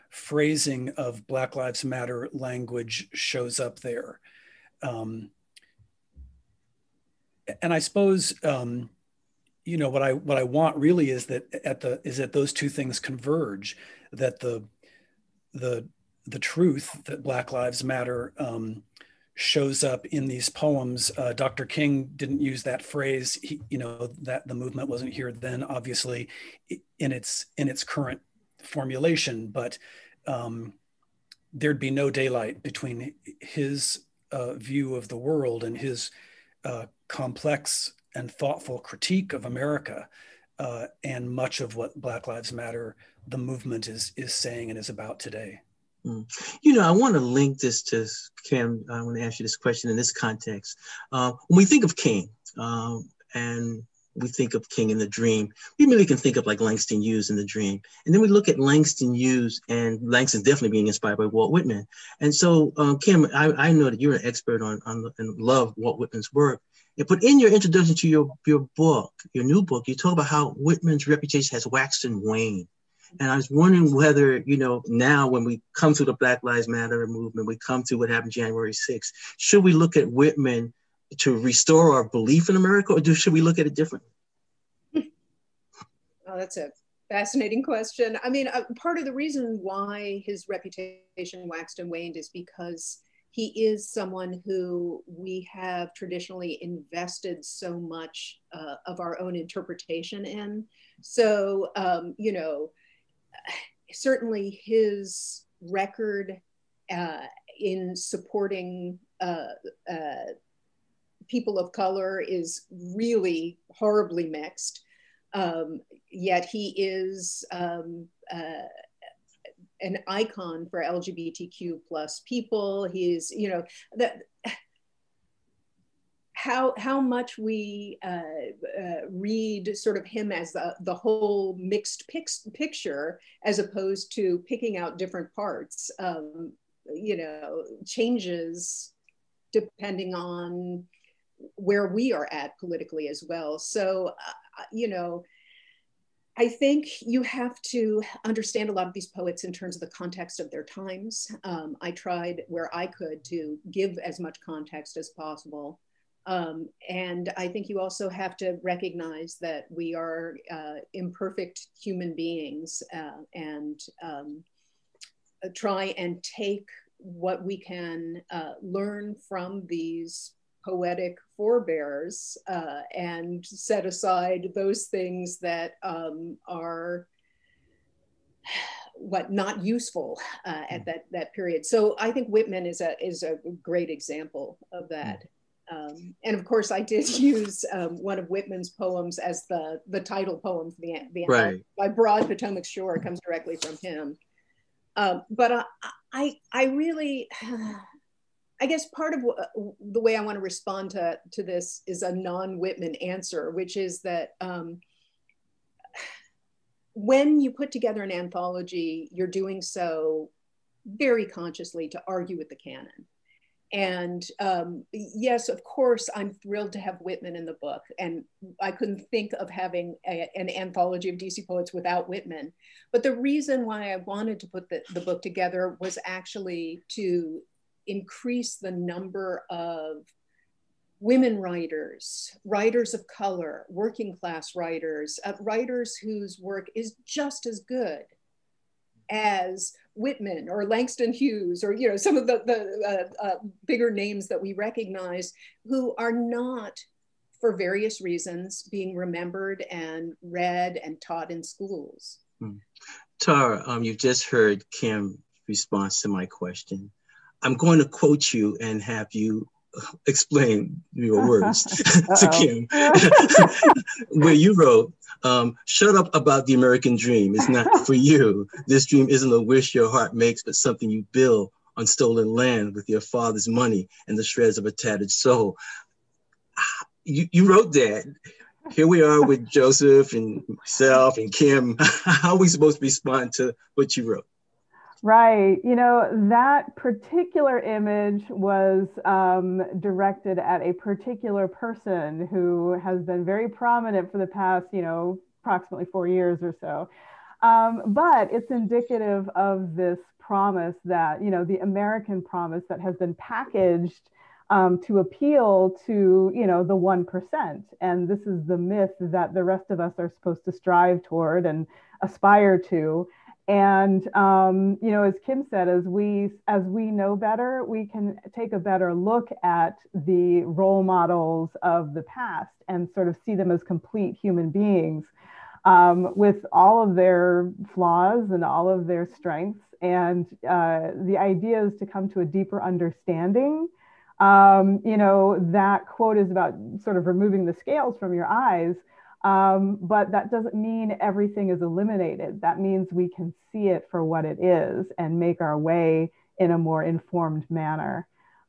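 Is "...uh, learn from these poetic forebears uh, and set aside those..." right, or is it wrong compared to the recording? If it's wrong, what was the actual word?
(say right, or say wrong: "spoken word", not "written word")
right.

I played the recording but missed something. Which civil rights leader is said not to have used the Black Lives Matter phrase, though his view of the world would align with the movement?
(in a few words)
Dr. King.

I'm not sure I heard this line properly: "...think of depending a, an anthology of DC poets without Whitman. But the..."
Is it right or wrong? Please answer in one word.
wrong.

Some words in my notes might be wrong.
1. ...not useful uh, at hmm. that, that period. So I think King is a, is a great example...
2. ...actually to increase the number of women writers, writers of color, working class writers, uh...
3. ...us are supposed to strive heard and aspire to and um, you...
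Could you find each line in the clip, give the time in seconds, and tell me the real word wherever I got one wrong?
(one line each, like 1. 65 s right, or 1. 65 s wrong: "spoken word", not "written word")
1. 179 s wrong: "Whitman", not "King"
2. 226 s right
3. 309 s wrong: "toward", not "heard".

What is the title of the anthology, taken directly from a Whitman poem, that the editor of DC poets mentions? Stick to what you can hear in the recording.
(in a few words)
By Broad Potomac Shore.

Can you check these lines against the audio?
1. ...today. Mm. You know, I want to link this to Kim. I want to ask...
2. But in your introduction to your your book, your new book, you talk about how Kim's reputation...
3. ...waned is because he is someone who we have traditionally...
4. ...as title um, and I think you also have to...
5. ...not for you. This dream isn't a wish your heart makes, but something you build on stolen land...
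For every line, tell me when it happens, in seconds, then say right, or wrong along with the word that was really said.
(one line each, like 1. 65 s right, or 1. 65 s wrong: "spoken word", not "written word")
1. 45 s right
2. 67 s wrong: "Whitman", not "Kim"
3. 91 s right
4. 154 s wrong: "possible", not "title"
5. 267 s right.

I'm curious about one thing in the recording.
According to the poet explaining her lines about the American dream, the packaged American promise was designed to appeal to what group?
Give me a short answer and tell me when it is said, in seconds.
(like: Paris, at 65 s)
the 1%, at 306 s.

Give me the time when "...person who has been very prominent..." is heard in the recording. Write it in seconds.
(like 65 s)
291 s.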